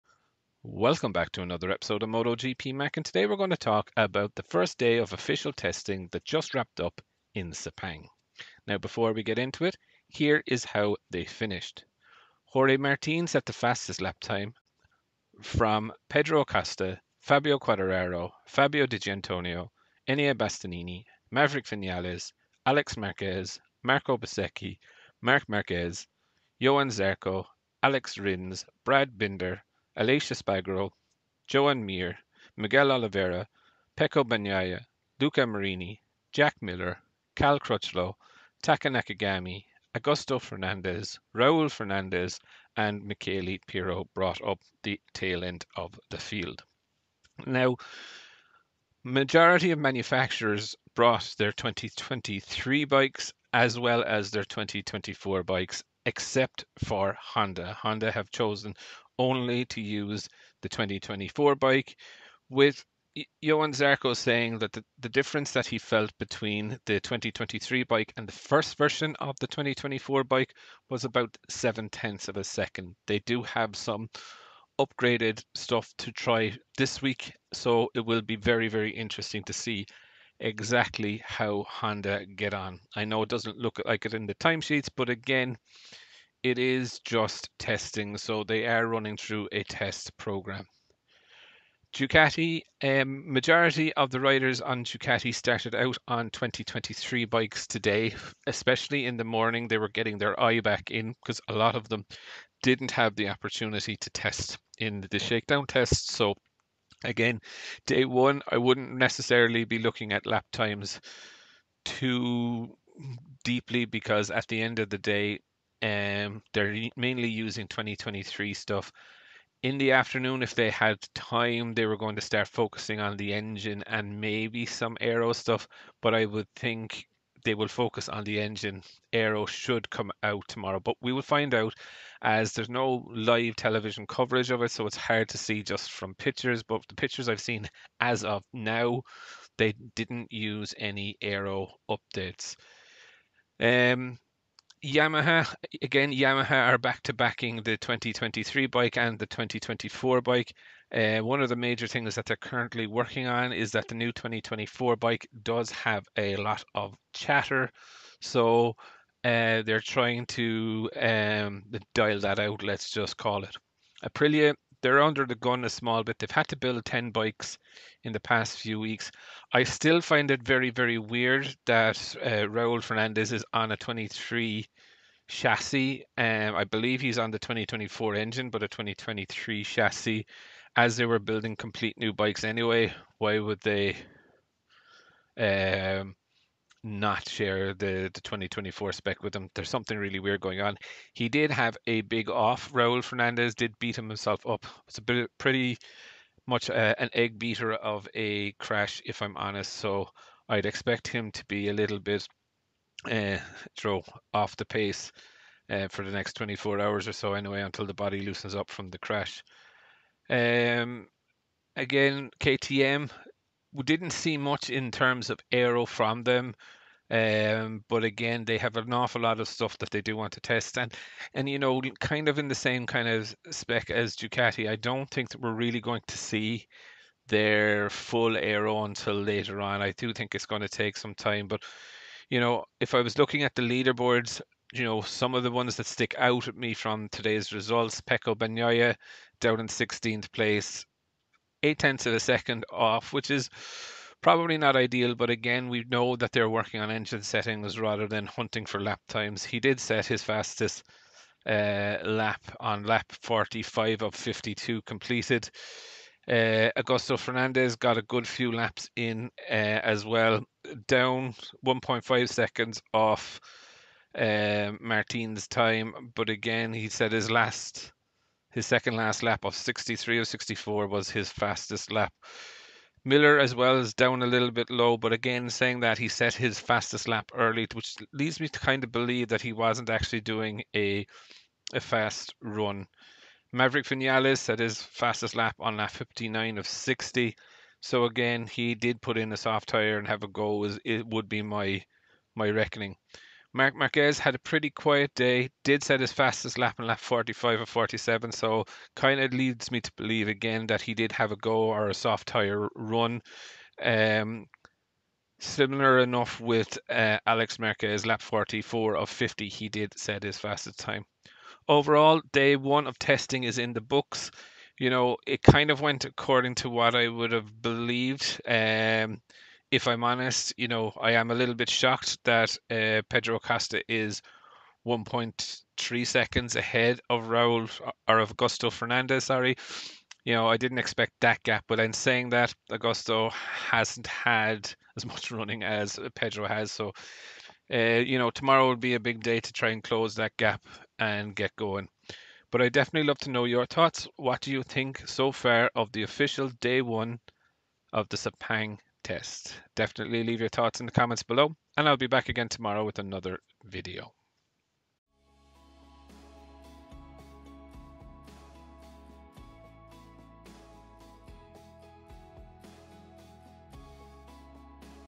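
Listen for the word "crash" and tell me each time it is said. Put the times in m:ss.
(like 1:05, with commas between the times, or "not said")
3:18, 3:28.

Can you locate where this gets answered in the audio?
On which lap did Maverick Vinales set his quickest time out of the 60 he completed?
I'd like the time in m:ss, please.
4:45.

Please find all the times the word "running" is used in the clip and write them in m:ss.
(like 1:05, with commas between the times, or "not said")
1:28, 5:35.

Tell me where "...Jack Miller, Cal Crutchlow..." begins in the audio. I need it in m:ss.
0:36.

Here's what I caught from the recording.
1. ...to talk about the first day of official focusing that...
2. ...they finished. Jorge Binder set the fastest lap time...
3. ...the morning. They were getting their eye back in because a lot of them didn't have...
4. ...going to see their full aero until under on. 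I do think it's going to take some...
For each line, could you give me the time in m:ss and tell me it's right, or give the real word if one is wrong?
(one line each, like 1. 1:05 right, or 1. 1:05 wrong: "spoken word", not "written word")
1. 0:03 wrong: "testing", not "focusing"
2. 0:11 wrong: "Martin", not "Binder"
3. 1:39 right
4. 3:45 wrong: "later", not "under".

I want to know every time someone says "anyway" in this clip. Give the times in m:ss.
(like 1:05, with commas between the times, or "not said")
3:02, 3:27.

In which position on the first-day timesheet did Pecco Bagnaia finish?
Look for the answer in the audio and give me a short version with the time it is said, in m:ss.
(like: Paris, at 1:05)
16th, at 3:59.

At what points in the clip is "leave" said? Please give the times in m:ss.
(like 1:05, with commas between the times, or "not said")
5:50.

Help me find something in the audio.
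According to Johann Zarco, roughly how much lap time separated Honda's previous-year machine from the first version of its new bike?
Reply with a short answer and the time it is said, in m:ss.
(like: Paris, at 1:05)
7 tenths of a second, at 1:11.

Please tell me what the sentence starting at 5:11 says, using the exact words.
Overall, day one of testing is in the books.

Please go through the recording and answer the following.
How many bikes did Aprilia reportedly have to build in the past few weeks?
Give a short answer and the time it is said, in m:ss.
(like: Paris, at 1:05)
10, at 2:46.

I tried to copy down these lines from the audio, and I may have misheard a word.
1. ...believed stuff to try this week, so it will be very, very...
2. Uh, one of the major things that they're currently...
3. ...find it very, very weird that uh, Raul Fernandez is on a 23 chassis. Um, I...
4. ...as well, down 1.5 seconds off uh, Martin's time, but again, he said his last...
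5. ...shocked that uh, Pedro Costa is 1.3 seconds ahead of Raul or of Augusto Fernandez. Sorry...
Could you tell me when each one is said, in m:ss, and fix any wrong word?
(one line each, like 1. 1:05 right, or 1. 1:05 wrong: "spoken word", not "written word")
1. 1:14 wrong: "upgraded", not "believed"
2. 2:30 right
3. 2:50 right
4. 4:19 right
5. 5:21 right.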